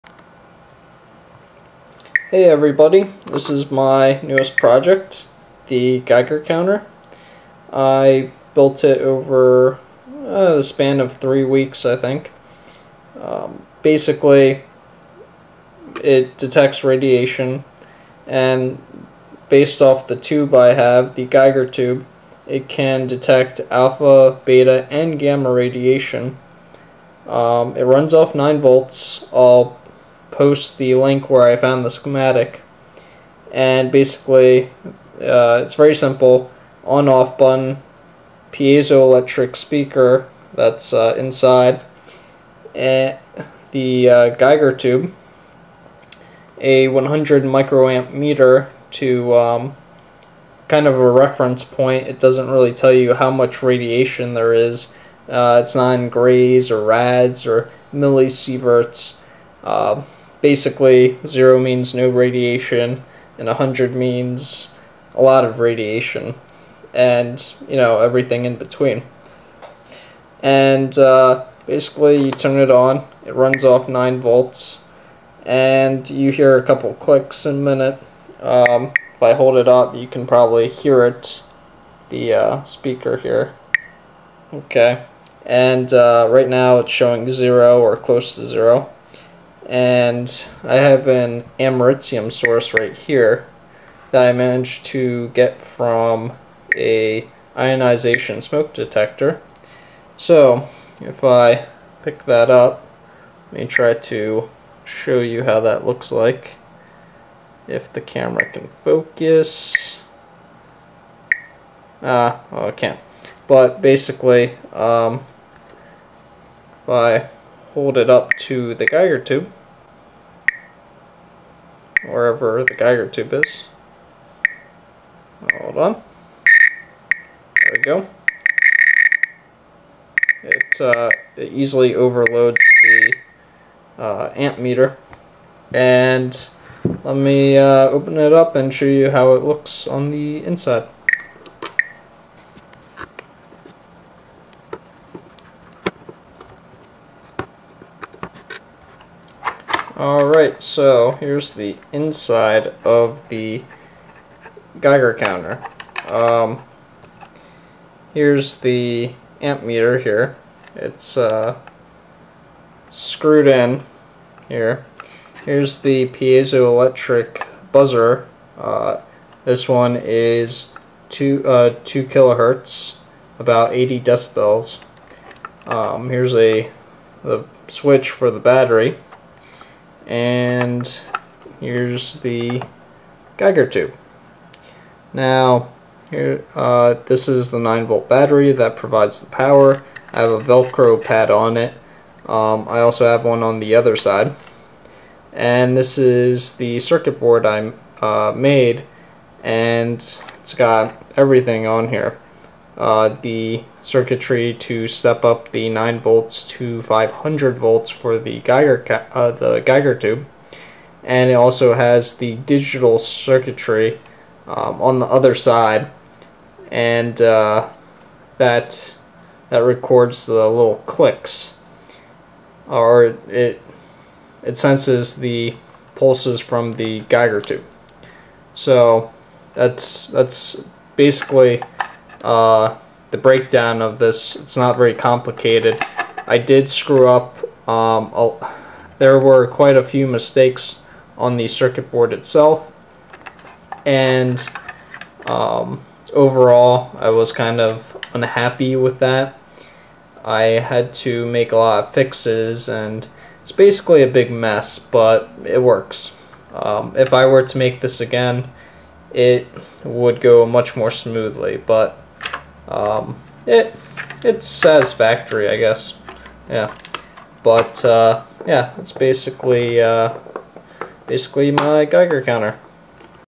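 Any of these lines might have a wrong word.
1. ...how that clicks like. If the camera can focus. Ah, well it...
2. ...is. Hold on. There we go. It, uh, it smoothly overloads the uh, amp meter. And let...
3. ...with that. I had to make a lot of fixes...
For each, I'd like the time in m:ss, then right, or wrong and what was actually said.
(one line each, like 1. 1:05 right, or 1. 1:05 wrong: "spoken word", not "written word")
1. 1:45 wrong: "looks", not "clicks"
2. 2:03 wrong: "easily", not "smoothly"
3. 4:08 right.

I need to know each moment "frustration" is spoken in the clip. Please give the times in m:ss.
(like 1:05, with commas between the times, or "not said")
not said.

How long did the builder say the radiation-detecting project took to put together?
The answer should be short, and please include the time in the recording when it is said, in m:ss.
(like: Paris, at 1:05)
3 weeks, at 0:11.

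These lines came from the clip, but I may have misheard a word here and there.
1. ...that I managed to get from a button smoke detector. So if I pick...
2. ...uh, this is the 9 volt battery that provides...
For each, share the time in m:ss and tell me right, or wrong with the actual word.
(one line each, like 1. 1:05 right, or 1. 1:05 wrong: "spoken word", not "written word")
1. 1:34 wrong: "ionization", not "button"
2. 3:06 right.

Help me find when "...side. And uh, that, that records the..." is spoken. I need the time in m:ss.
3:35.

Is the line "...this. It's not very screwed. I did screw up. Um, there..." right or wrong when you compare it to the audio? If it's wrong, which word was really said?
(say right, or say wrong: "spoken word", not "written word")
wrong: "complicated", not "screwed".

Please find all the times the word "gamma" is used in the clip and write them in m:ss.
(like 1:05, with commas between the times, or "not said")
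0:25.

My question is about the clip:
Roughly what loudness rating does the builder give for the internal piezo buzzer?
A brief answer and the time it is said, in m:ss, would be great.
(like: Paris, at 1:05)
80 decibels, at 2:53.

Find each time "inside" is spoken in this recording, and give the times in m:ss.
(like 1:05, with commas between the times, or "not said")
0:41, 2:20, 2:31.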